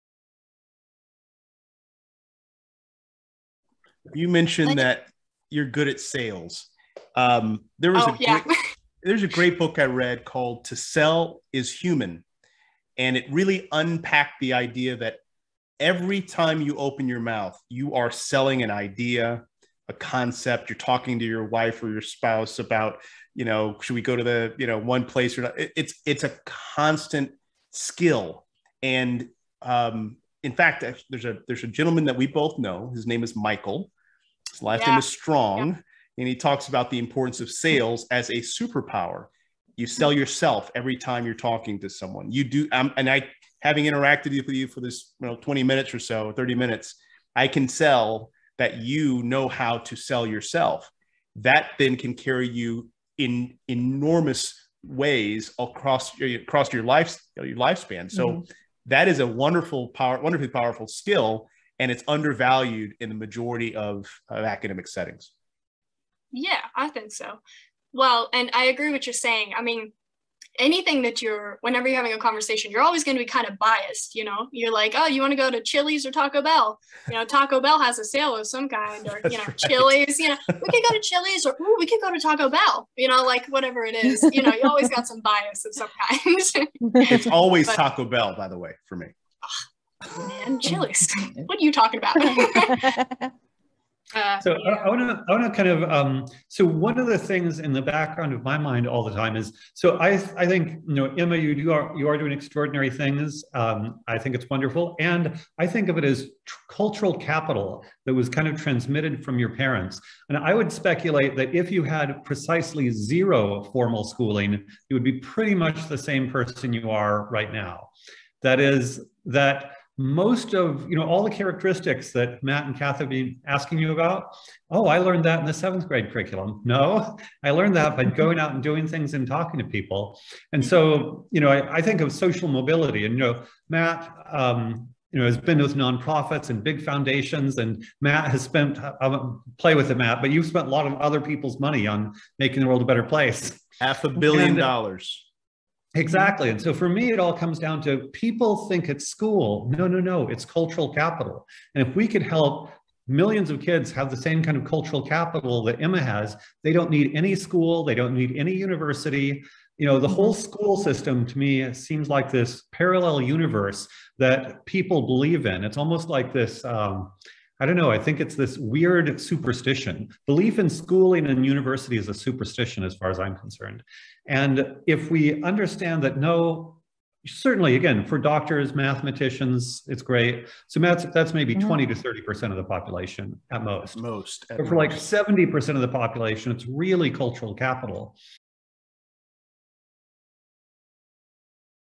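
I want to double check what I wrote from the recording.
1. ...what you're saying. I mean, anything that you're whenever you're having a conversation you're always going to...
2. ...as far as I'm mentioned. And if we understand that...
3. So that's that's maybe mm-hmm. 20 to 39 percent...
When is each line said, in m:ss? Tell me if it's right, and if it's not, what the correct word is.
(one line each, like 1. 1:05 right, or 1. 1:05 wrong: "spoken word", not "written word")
1. 1:08 right
2. 2:52 wrong: "concerned", not "mentioned"
3. 3:00 wrong: "30", not "39".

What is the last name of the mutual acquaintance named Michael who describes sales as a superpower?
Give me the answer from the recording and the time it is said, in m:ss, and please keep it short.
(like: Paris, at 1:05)
Strong, at 0:35.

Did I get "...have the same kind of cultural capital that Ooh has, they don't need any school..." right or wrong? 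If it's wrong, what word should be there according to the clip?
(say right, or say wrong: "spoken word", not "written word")
wrong: "Emma", not "Ooh".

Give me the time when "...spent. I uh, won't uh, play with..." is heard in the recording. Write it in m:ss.
2:18.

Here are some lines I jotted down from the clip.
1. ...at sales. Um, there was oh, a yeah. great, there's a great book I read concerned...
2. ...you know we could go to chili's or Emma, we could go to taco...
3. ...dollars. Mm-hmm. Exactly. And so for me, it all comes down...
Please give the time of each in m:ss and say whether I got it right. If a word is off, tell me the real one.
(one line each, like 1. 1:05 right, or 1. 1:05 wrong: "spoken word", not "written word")
1. 0:05 wrong: "called", not "concerned"
2. 1:20 wrong: "Ooh", not "Emma"
3. 2:24 right.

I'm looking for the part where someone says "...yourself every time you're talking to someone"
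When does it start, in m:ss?
0:40.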